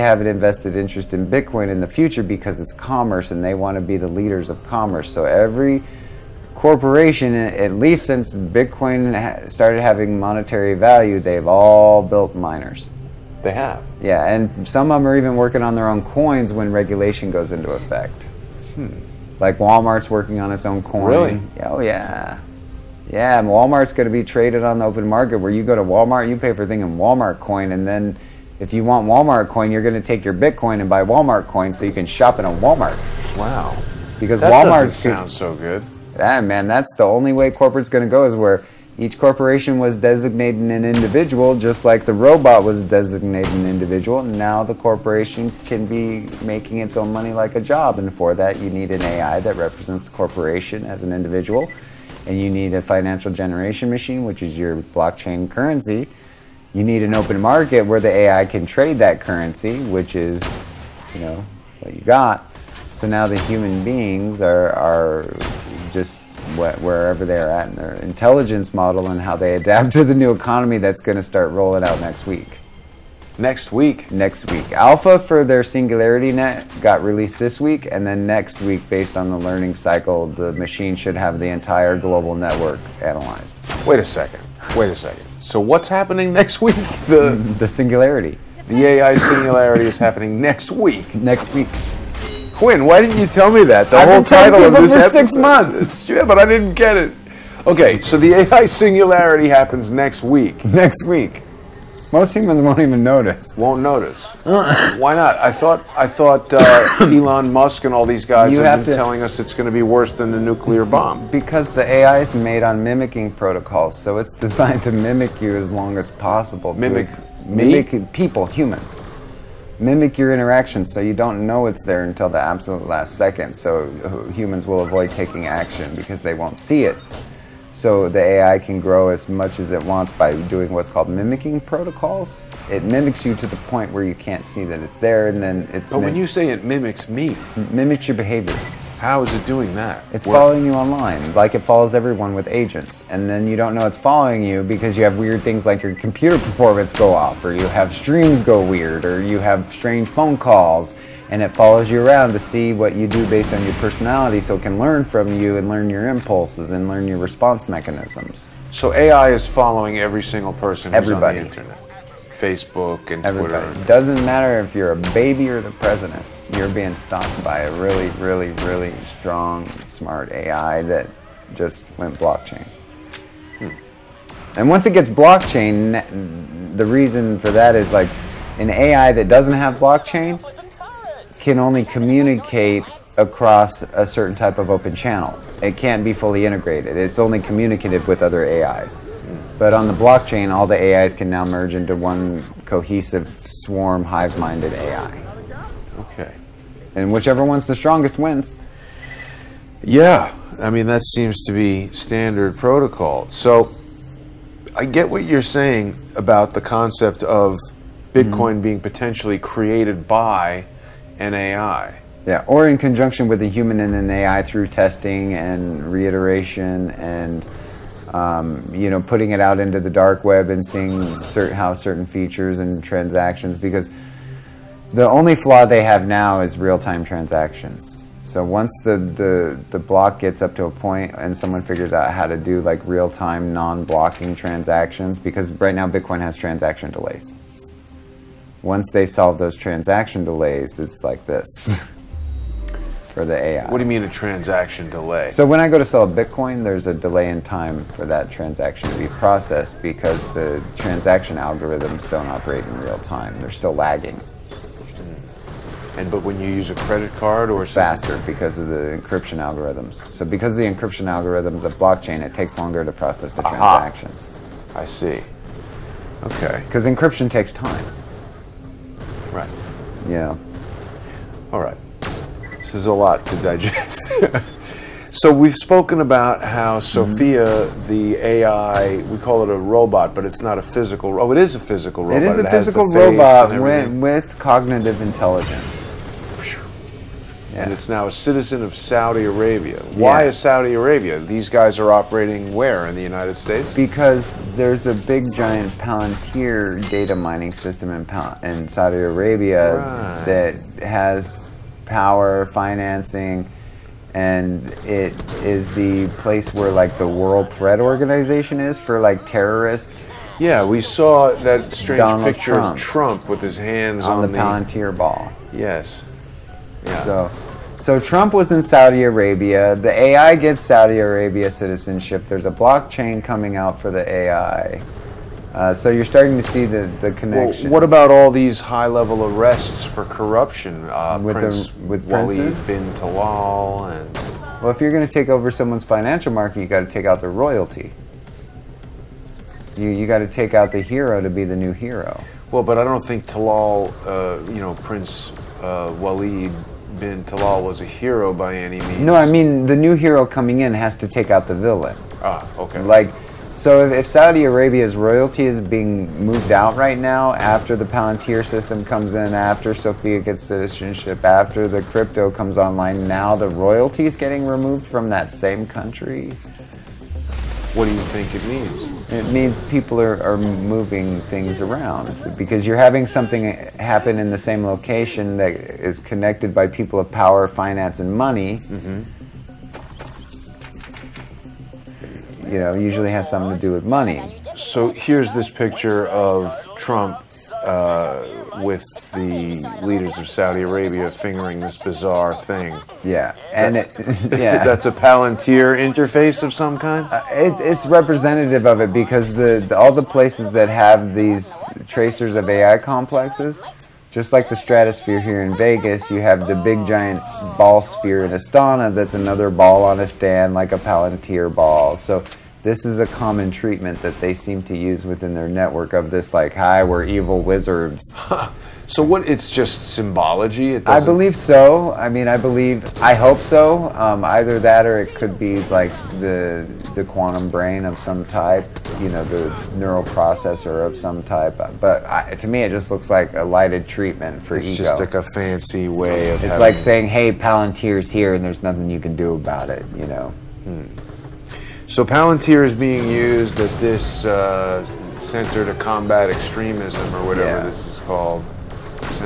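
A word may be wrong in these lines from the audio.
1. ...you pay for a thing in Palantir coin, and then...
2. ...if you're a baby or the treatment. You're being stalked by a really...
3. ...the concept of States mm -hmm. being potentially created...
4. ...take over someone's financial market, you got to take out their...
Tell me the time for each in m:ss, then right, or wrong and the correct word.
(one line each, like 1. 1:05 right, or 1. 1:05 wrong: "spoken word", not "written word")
1. 0:26 wrong: "Walmart", not "Palantir"
2. 2:44 wrong: "president", not "treatment"
3. 3:26 wrong: "Bitcoin", not "States"
4. 5:35 right.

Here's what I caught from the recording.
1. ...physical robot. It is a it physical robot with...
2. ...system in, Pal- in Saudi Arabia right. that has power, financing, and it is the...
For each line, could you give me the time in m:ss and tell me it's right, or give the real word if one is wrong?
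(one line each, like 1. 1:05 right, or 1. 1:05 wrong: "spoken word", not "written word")
1. 4:41 right
2. 4:57 right.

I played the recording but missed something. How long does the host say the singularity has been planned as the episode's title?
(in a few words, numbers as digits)
six months.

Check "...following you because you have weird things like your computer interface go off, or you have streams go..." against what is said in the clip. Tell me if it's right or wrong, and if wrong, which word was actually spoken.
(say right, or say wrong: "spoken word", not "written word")
wrong: "performance", not "interface".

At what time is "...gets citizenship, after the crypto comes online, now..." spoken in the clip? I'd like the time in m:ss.
6:00.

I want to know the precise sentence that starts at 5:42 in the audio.
Well, but I don't think Talal, uh, you know, Prince uh, bin Talal was a hero by any means.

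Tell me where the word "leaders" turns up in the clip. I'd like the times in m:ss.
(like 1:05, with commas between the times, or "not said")
0:04, 6:29.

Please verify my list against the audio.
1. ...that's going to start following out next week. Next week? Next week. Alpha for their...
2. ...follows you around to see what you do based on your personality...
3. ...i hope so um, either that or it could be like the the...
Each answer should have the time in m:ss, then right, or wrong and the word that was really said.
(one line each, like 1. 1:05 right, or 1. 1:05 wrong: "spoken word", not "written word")
1. 1:10 wrong: "rolling", not "following"
2. 2:31 right
3. 7:03 right.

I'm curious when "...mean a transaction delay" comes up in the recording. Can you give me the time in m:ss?
4:03.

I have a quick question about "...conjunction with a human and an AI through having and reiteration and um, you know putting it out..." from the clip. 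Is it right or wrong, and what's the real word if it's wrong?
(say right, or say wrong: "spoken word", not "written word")
wrong: "testing", not "having".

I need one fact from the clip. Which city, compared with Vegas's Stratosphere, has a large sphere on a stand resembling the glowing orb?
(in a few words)
Astana.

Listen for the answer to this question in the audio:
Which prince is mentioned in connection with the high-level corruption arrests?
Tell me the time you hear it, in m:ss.
5:32.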